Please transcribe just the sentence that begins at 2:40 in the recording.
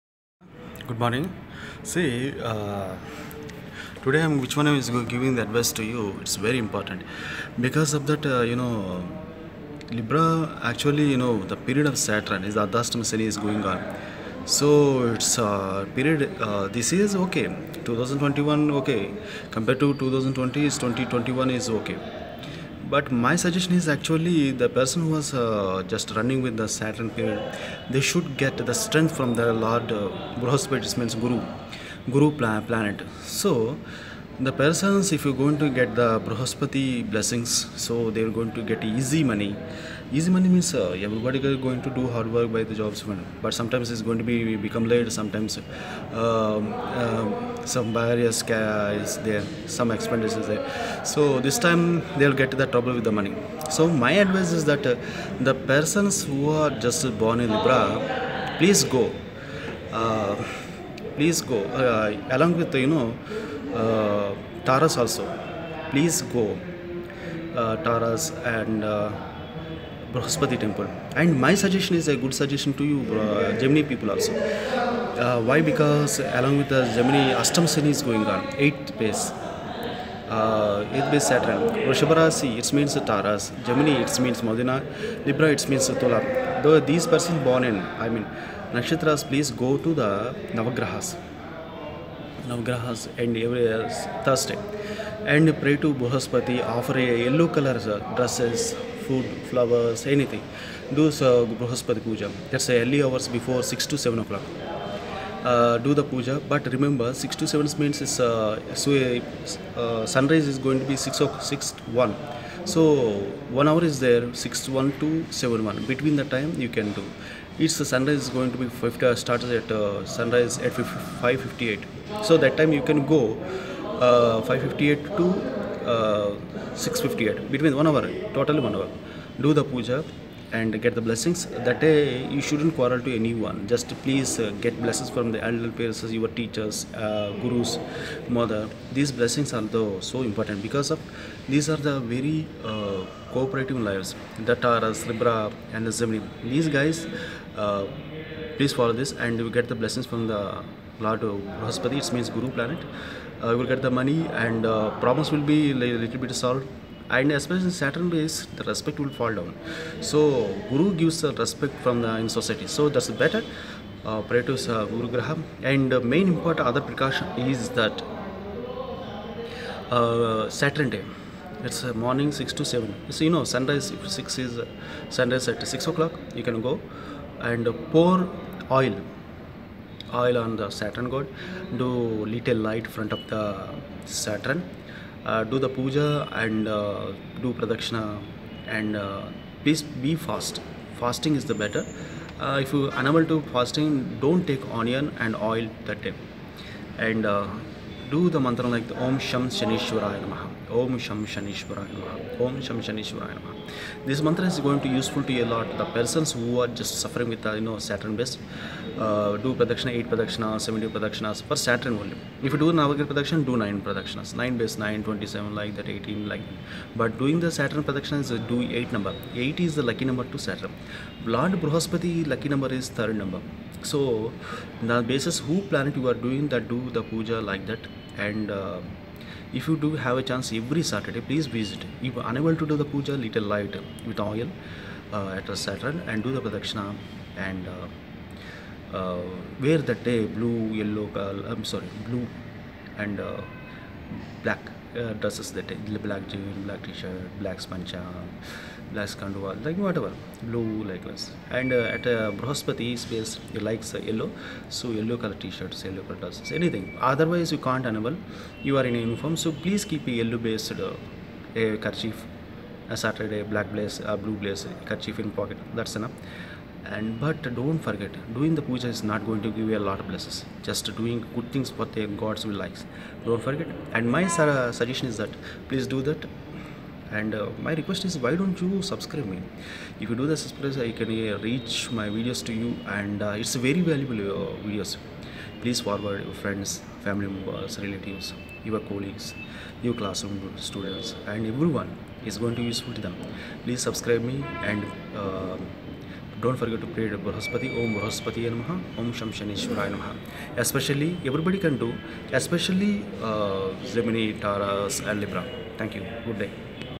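So Guru gives the respect from the in society.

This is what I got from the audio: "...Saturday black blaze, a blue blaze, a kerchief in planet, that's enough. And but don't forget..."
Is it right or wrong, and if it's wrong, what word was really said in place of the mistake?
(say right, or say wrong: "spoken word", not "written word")
wrong: "pocket", not "planet".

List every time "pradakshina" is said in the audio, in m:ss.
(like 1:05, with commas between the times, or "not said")
3:07, 3:56.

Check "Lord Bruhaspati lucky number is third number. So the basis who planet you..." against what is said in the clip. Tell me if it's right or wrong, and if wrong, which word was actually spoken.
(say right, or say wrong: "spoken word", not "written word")
right.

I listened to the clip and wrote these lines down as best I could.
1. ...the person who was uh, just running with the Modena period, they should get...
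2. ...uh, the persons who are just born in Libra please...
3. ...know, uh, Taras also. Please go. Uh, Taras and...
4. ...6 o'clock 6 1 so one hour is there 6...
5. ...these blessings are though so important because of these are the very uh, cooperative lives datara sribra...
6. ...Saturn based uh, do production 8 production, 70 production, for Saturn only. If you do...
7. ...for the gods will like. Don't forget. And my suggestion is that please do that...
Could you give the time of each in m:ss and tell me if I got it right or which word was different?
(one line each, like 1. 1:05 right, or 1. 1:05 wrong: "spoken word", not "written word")
1. 0:24 wrong: "Saturn", not "Modena"
2. 0:54 right
3. 1:02 right
4. 1:50 right
5. 2:18 right
6. 3:27 right
7. 4:31 right.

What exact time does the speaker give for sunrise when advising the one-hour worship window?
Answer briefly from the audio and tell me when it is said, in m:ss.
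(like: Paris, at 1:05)
5:58, at 2:00.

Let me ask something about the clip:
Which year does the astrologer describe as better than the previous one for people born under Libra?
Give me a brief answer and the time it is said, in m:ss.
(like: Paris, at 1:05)
2021, at 0:20.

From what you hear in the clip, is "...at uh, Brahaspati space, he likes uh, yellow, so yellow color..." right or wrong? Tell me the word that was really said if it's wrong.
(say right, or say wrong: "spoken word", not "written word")
right.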